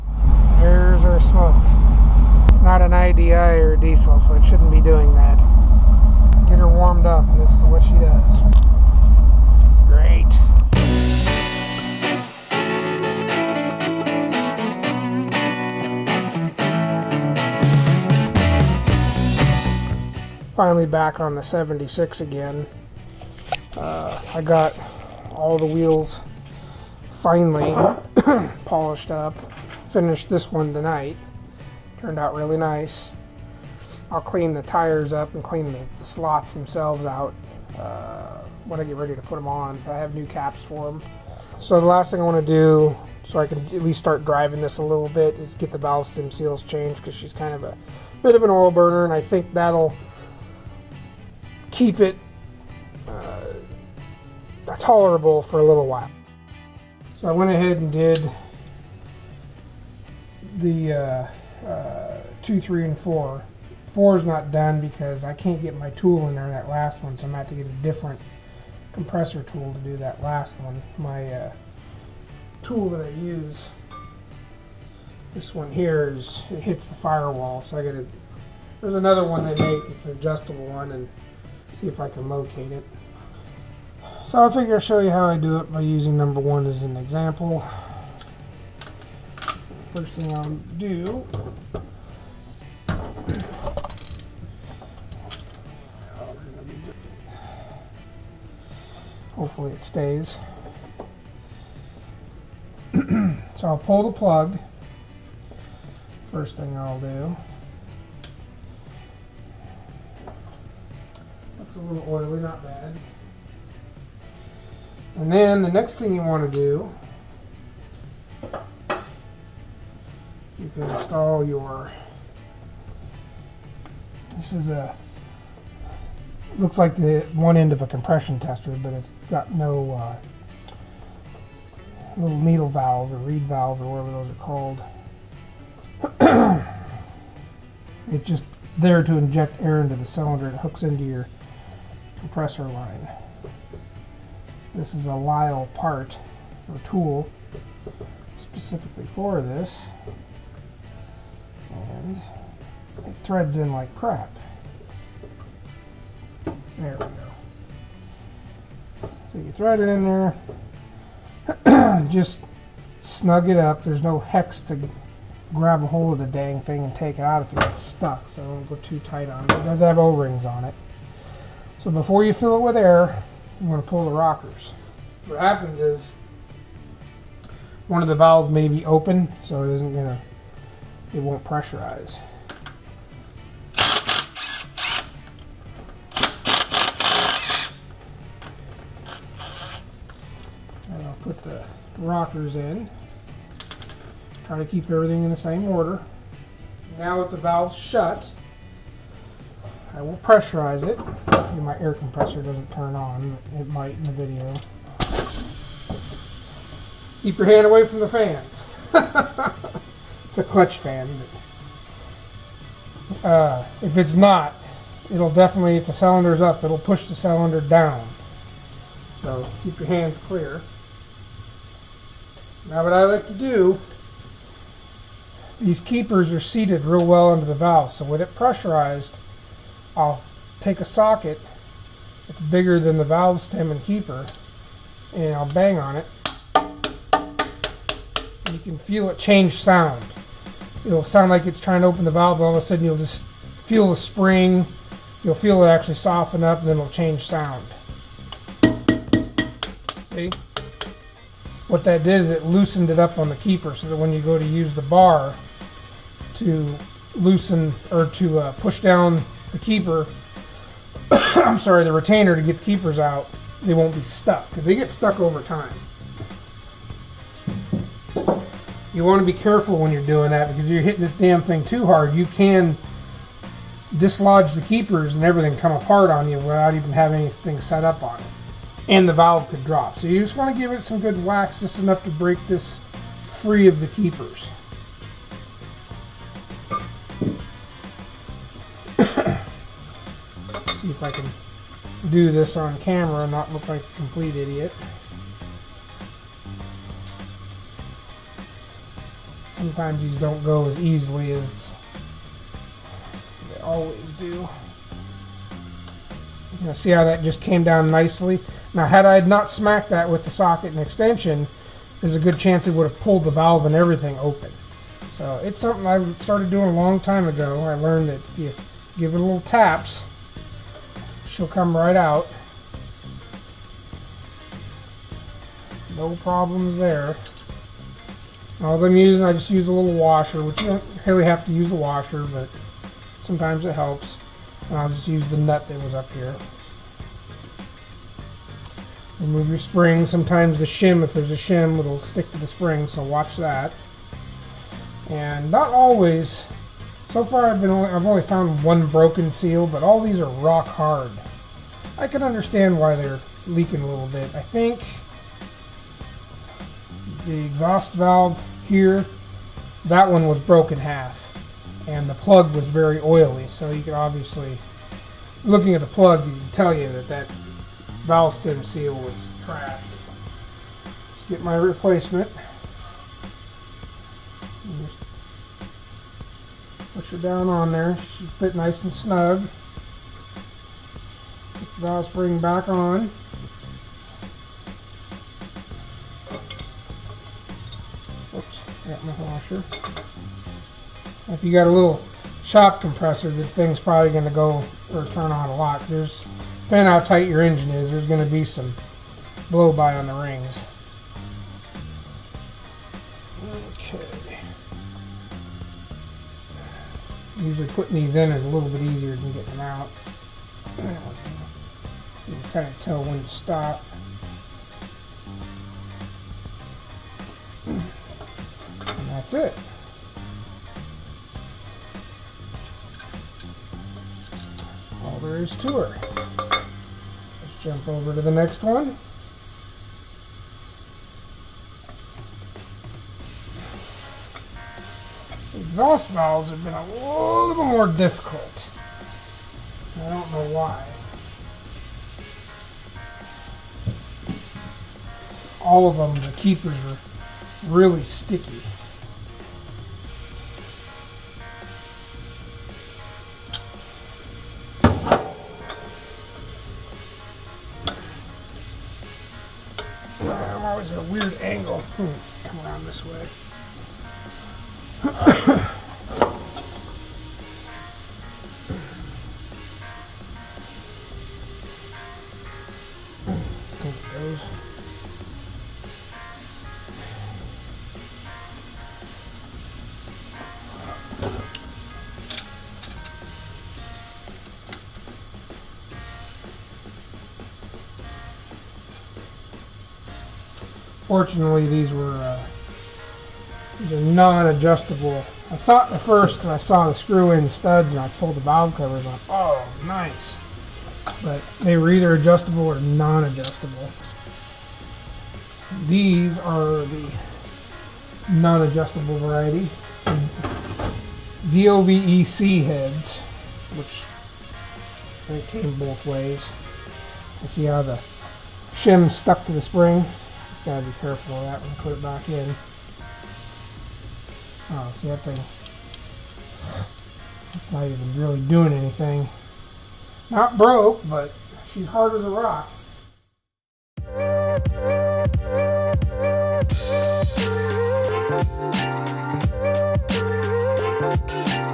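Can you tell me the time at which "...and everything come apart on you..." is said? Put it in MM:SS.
04:35.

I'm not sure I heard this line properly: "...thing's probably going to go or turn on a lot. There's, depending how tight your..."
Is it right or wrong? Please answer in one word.
right.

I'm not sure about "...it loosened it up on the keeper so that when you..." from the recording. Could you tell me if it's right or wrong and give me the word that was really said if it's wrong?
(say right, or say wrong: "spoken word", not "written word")
right.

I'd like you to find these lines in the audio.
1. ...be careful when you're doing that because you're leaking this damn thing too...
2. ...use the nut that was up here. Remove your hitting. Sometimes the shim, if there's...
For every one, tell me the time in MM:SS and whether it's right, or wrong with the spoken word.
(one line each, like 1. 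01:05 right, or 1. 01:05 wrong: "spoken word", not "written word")
1. 04:29 wrong: "hitting", not "leaking"
2. 05:35 wrong: "spring", not "hitting".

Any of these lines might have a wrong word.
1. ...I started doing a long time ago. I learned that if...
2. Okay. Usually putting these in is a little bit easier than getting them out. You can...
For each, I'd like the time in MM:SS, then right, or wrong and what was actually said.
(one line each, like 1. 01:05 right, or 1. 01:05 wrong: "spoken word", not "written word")
1. 05:15 right
2. 06:43 right.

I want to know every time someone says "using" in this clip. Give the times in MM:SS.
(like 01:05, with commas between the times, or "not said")
01:25, 05:28.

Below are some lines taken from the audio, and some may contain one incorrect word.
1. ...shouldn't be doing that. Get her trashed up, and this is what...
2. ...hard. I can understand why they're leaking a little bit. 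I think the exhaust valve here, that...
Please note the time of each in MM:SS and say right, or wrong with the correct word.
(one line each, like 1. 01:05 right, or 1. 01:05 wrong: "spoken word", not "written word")
1. 00:04 wrong: "warmed", not "trashed"
2. 05:50 right.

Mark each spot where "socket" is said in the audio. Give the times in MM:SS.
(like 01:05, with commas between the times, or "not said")
03:50, 05:10.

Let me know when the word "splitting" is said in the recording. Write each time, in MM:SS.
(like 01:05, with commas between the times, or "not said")
not said.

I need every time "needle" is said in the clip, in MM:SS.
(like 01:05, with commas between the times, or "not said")
02:12.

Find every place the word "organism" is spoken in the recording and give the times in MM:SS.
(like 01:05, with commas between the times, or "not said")
not said.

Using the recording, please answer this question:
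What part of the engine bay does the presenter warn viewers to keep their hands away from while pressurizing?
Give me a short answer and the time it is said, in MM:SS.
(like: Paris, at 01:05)
clutch fan, at 03:30.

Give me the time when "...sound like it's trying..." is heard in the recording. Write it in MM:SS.
04:01.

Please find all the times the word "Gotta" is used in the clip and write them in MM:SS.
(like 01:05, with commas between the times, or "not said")
08:40.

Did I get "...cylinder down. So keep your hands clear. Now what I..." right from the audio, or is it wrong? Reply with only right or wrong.
right.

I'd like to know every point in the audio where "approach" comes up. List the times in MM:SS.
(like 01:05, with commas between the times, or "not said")
not said.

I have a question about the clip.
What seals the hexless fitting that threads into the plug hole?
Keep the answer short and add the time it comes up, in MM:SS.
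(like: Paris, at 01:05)
O-rings, at 02:49.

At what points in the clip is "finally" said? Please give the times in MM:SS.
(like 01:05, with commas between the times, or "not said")
00:20, 00:27.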